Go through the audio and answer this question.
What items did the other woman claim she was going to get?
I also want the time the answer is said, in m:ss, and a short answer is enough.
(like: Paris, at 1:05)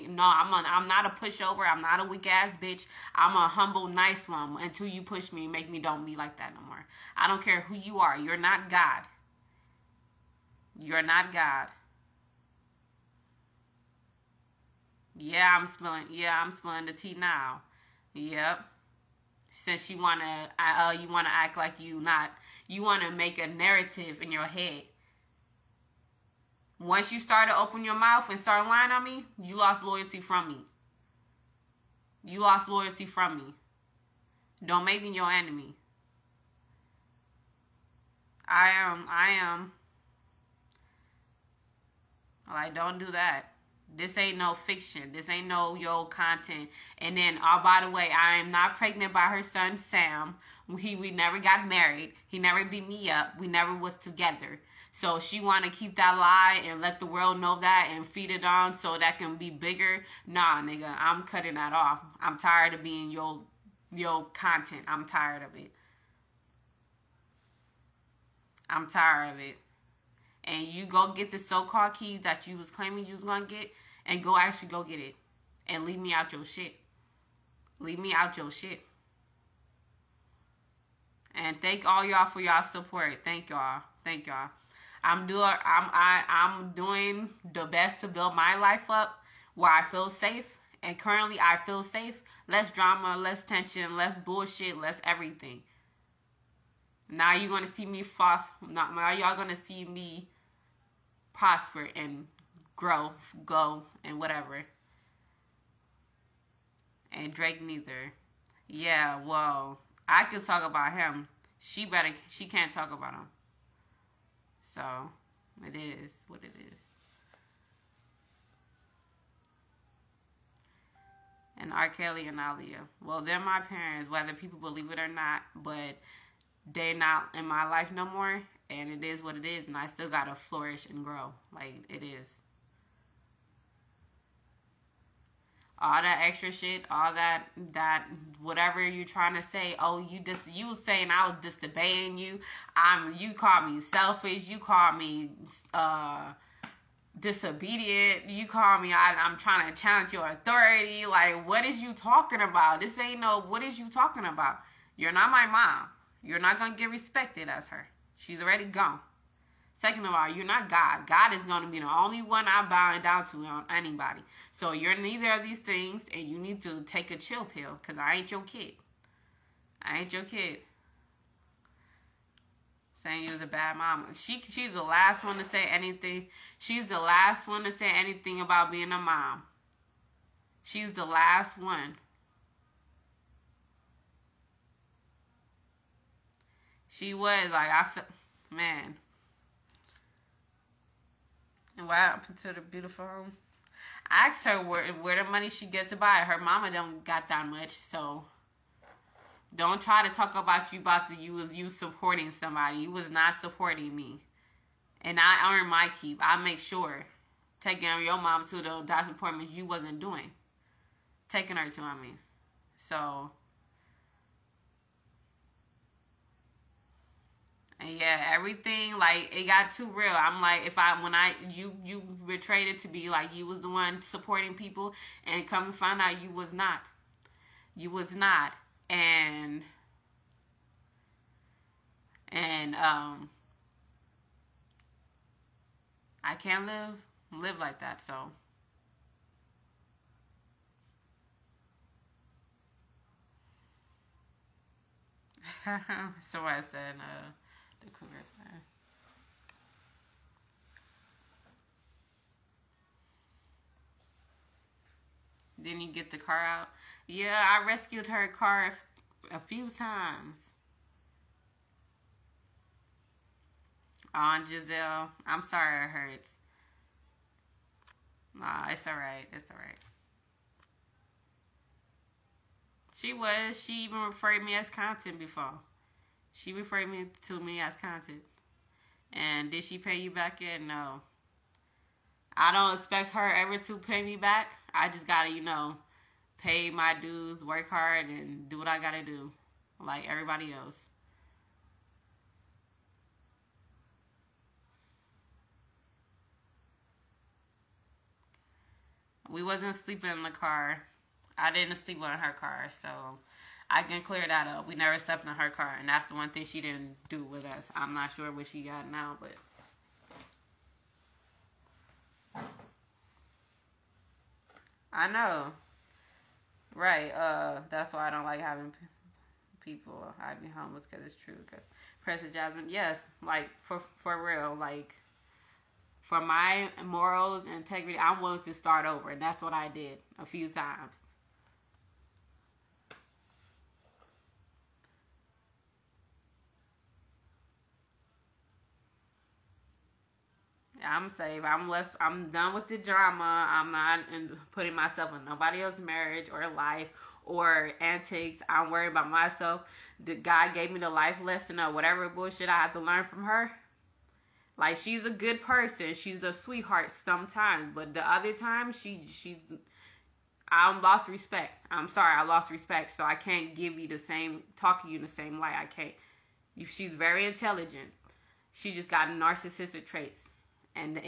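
Keys, at 1:11.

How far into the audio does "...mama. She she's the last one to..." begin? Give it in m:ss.
2:53.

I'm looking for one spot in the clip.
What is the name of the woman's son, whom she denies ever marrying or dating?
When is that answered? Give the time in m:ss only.
0:49.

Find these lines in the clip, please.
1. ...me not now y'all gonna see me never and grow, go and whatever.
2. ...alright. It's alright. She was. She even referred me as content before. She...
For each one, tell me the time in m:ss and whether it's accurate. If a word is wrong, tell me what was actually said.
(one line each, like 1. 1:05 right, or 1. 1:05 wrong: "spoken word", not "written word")
1. 1:37 wrong: "prosper", not "never"
2. 4:28 right.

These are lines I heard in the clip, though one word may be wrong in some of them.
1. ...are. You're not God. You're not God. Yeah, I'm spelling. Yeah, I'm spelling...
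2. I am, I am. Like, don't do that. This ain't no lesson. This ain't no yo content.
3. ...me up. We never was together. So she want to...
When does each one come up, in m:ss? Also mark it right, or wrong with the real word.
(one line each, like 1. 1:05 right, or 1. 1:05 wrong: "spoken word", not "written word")
1. 0:07 right
2. 0:38 wrong: "fiction", not "lesson"
3. 0:52 right.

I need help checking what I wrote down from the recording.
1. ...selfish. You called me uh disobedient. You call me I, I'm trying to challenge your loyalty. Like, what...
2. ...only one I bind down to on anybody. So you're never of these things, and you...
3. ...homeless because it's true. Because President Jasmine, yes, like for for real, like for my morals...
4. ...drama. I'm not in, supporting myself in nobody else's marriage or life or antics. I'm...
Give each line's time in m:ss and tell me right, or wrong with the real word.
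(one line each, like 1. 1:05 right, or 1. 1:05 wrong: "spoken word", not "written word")
1. 2:23 wrong: "authority", not "loyalty"
2. 2:41 wrong: "neither", not "never"
3. 5:20 right
4. 5:42 wrong: "putting", not "supporting".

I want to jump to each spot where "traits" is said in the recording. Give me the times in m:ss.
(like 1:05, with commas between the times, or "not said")
6:09.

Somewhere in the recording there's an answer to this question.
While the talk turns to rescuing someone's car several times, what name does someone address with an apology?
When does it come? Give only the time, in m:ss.
4:24.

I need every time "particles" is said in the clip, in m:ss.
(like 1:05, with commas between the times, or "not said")
not said.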